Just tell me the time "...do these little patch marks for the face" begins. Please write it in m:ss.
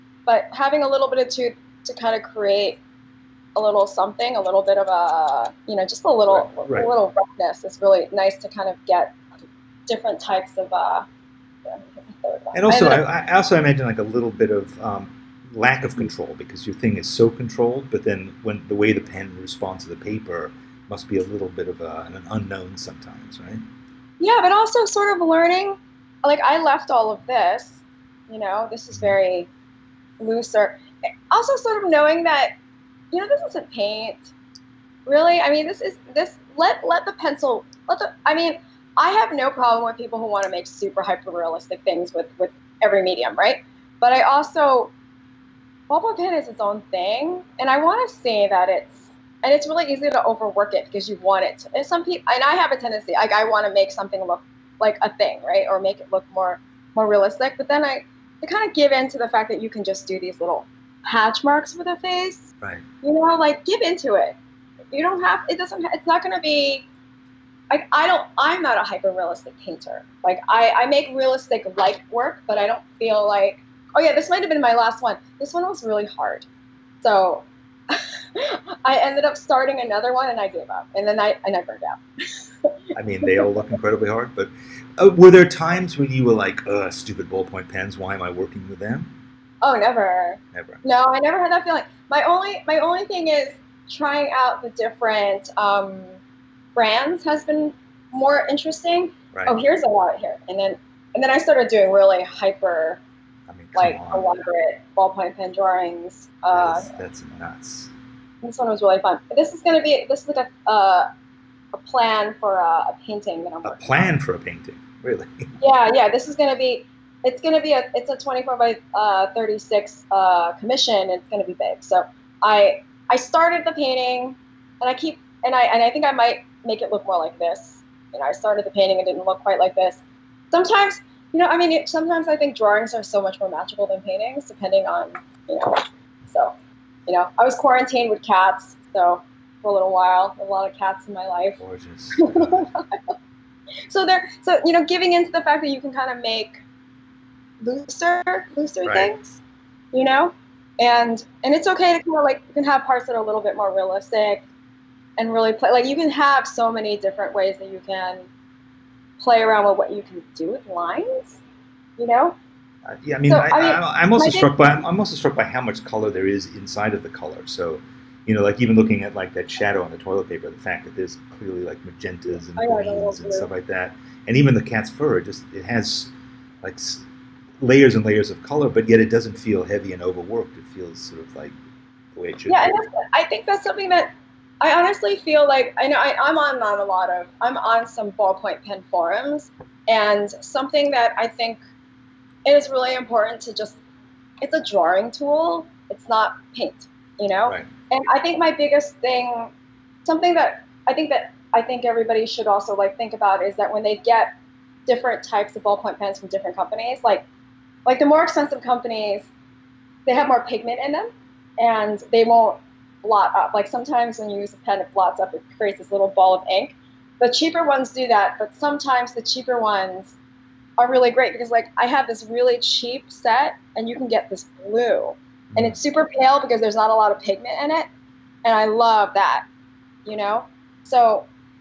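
1:00.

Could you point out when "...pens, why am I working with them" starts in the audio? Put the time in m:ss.
1:27.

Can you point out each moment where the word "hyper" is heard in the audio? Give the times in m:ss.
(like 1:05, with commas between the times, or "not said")
0:41, 1:08, 1:42.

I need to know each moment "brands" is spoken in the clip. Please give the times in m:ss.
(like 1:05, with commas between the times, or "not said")
1:36.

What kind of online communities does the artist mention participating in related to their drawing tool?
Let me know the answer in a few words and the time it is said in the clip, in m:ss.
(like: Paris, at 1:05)
Ballpoint pen forums, at 3:08.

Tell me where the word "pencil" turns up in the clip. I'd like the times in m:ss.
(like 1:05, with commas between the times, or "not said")
0:37.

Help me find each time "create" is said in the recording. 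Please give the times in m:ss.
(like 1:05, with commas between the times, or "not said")
0:02, 3:35.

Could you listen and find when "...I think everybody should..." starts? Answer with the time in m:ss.
3:21.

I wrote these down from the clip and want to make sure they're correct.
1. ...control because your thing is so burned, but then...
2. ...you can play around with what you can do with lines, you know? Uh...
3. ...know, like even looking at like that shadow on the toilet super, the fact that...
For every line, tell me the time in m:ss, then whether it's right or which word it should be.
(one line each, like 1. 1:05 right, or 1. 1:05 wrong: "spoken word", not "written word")
1. 0:15 wrong: "controlled", not "burned"
2. 2:37 right
3. 2:48 wrong: "paper", not "super".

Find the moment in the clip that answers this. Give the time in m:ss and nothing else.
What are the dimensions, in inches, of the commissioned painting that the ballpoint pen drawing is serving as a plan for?
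1:58.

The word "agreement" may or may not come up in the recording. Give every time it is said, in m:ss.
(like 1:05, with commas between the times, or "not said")
not said.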